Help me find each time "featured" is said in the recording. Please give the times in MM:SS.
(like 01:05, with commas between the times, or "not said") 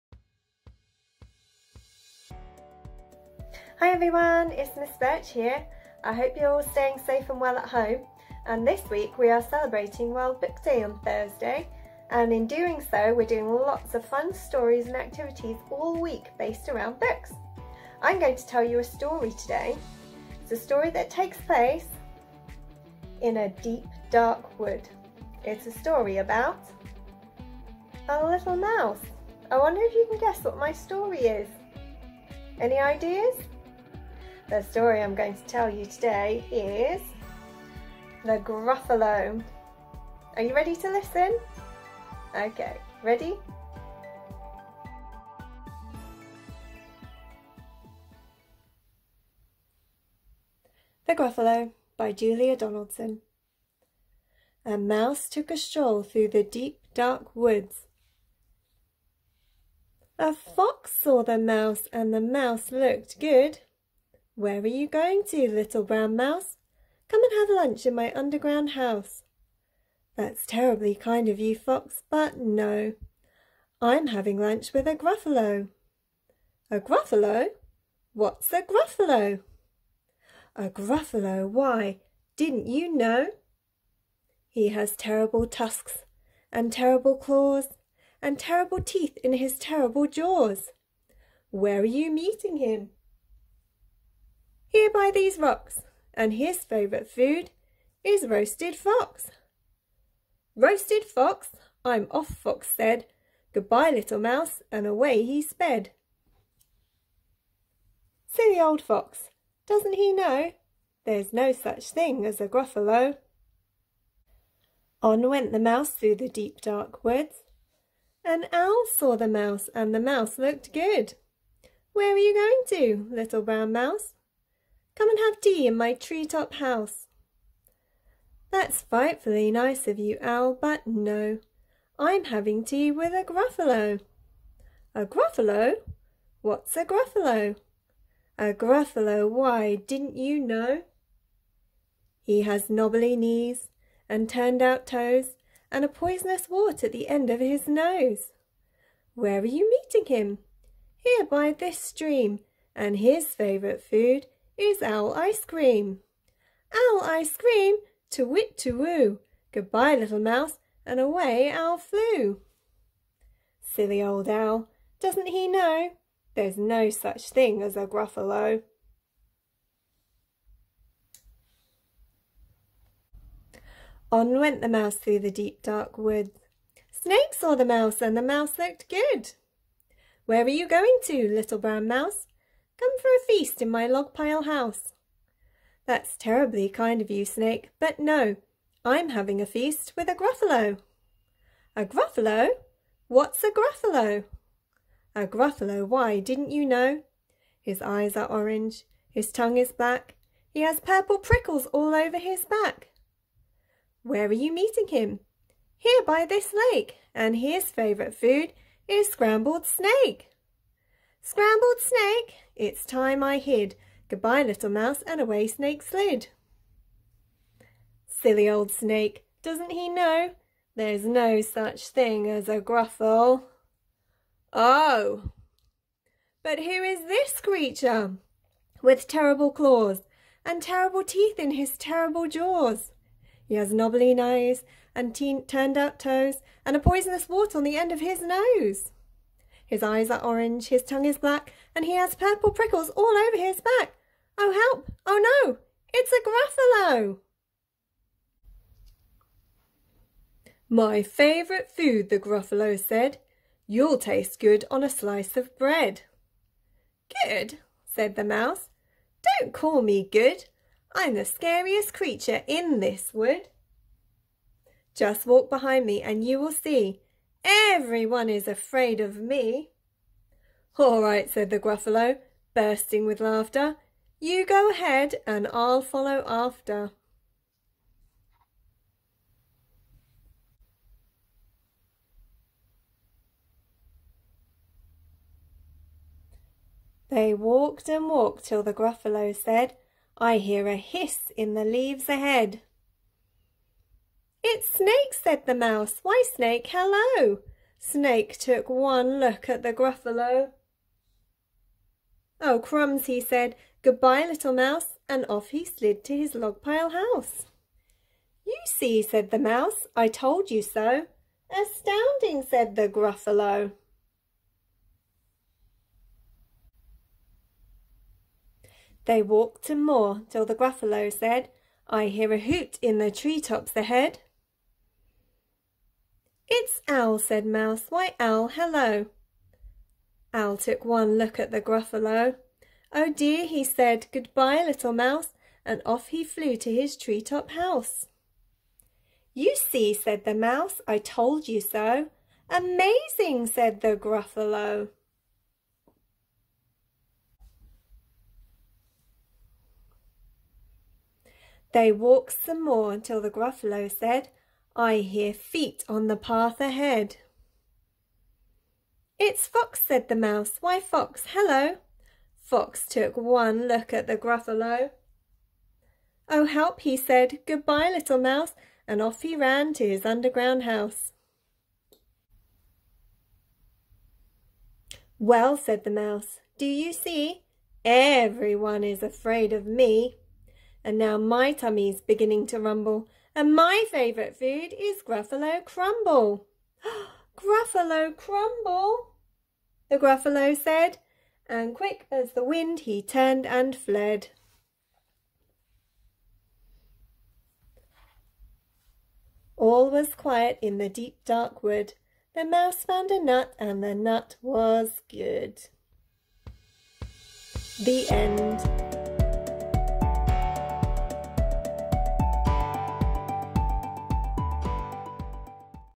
not said.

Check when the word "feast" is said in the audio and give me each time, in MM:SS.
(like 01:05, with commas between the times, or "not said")
03:03, 03:09.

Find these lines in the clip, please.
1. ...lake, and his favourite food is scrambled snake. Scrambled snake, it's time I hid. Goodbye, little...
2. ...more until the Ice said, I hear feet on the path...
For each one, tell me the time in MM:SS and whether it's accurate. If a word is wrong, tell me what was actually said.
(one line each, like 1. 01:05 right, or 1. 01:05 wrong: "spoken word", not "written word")
1. 03:26 right
2. 05:52 wrong: "Gruffalo", not "Ice".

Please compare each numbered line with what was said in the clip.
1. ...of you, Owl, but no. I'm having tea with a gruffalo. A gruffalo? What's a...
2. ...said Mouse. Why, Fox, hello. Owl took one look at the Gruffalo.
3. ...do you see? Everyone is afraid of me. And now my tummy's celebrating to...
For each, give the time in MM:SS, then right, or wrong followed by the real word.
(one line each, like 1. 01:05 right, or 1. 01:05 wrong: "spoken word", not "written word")
1. 02:09 right
2. 05:27 wrong: "Owl", not "Fox"
3. 06:16 wrong: "beginning", not "celebrating".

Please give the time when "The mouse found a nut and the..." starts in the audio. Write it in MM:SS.
06:42.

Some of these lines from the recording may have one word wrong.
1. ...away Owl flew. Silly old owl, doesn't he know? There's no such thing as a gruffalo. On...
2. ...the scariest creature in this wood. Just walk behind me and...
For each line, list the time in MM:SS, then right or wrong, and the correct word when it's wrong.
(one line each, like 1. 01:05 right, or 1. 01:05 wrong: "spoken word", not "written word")
1. 02:40 right
2. 04:21 right.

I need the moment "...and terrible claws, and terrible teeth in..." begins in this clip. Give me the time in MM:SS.
01:26.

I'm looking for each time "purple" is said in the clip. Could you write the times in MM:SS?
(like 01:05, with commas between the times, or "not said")
03:20, 04:02.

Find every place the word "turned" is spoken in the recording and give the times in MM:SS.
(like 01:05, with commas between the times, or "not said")
02:24, 03:55, 06:33.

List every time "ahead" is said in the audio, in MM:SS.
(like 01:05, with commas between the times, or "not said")
04:34, 04:52, 05:23, 05:56.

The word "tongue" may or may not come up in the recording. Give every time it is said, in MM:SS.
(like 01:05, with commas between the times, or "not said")
03:19, 04:00.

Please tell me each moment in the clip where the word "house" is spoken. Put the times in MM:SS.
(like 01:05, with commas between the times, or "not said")
01:08, 02:06, 03:04, 05:06, 05:37, 06:10.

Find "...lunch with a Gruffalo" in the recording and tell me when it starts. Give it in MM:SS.
01:14.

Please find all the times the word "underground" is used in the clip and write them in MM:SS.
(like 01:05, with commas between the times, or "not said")
01:08, 06:10.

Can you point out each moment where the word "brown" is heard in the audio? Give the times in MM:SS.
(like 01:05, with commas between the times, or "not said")
01:05, 02:03, 03:01.